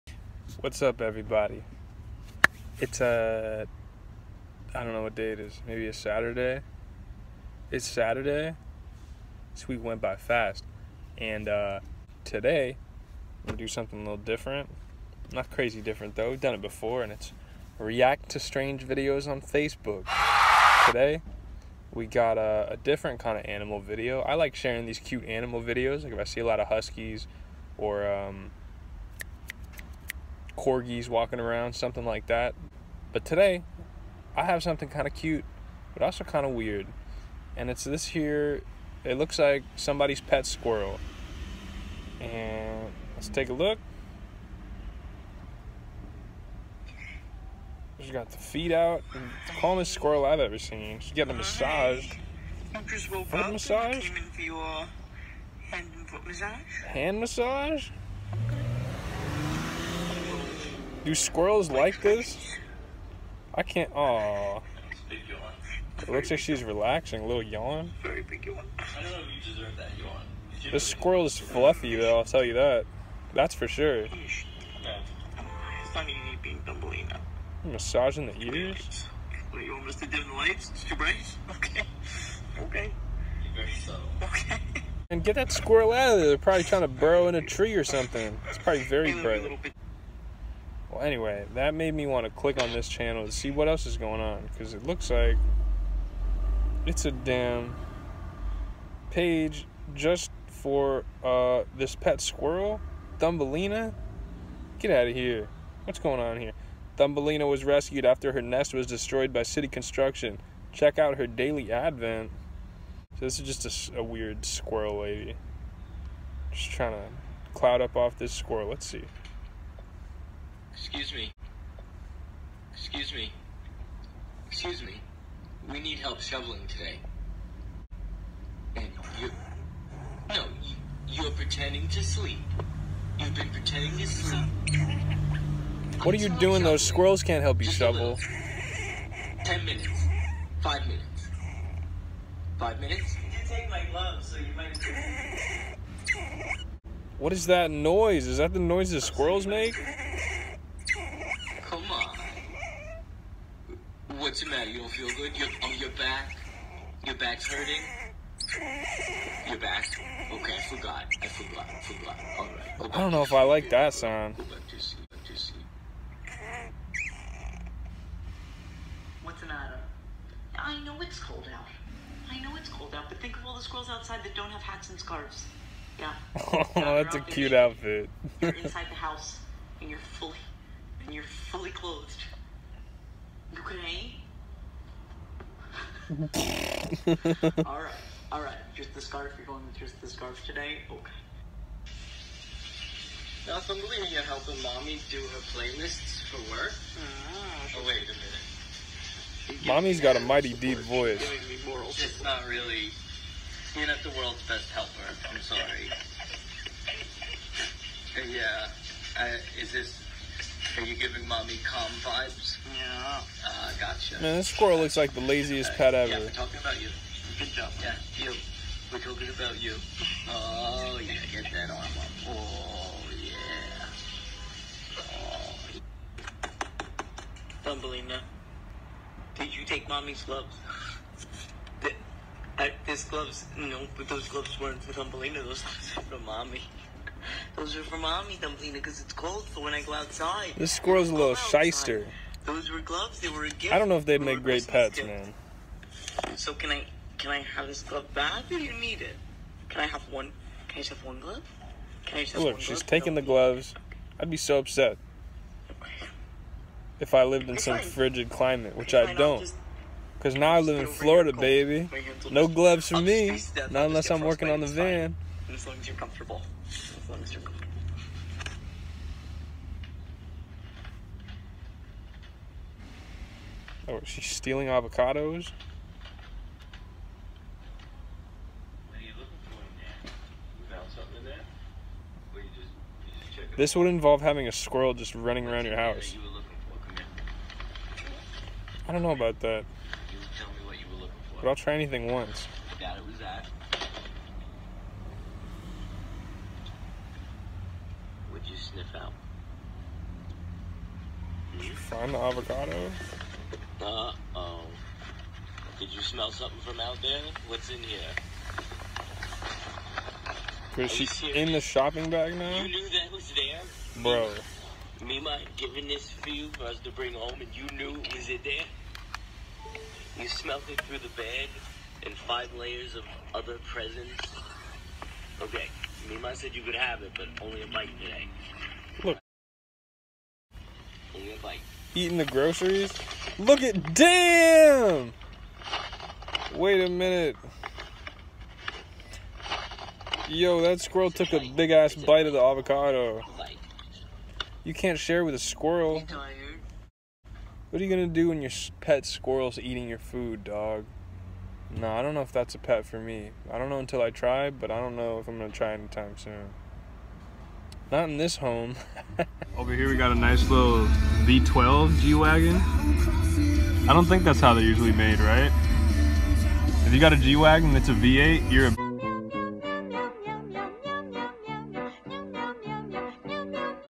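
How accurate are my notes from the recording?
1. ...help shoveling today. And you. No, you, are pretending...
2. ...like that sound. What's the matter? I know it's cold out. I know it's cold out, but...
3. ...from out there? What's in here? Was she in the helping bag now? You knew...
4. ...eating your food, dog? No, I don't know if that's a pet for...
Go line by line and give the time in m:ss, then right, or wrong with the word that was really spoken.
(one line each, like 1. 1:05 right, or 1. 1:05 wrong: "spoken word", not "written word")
1. 2:05 right
2. 2:43 right
3. 5:06 wrong: "shopping", not "helping"
4. 5:49 right.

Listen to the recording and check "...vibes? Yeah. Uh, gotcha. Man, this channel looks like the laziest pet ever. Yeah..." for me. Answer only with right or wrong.
wrong.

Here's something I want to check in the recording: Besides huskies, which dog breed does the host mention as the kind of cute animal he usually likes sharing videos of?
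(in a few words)
Corgis.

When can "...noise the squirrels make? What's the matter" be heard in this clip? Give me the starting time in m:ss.
2:28.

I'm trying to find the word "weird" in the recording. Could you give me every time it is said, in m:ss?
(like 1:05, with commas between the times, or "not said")
0:36, 1:54.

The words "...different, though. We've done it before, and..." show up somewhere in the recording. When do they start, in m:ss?
0:15.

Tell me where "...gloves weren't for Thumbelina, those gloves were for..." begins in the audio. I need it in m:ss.
3:54.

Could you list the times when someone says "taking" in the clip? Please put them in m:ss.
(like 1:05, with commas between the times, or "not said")
4:12.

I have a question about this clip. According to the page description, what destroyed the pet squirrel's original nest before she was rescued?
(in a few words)
City construction.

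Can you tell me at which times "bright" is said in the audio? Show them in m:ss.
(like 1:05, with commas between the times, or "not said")
1:20, 1:29.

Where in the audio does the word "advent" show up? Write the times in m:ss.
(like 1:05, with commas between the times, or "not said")
1:51.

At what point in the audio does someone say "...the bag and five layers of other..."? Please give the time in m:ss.
5:20.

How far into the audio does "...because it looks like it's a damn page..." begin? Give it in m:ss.
1:34.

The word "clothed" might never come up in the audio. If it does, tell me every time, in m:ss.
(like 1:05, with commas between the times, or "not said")
3:01.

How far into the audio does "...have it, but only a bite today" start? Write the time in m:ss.
5:26.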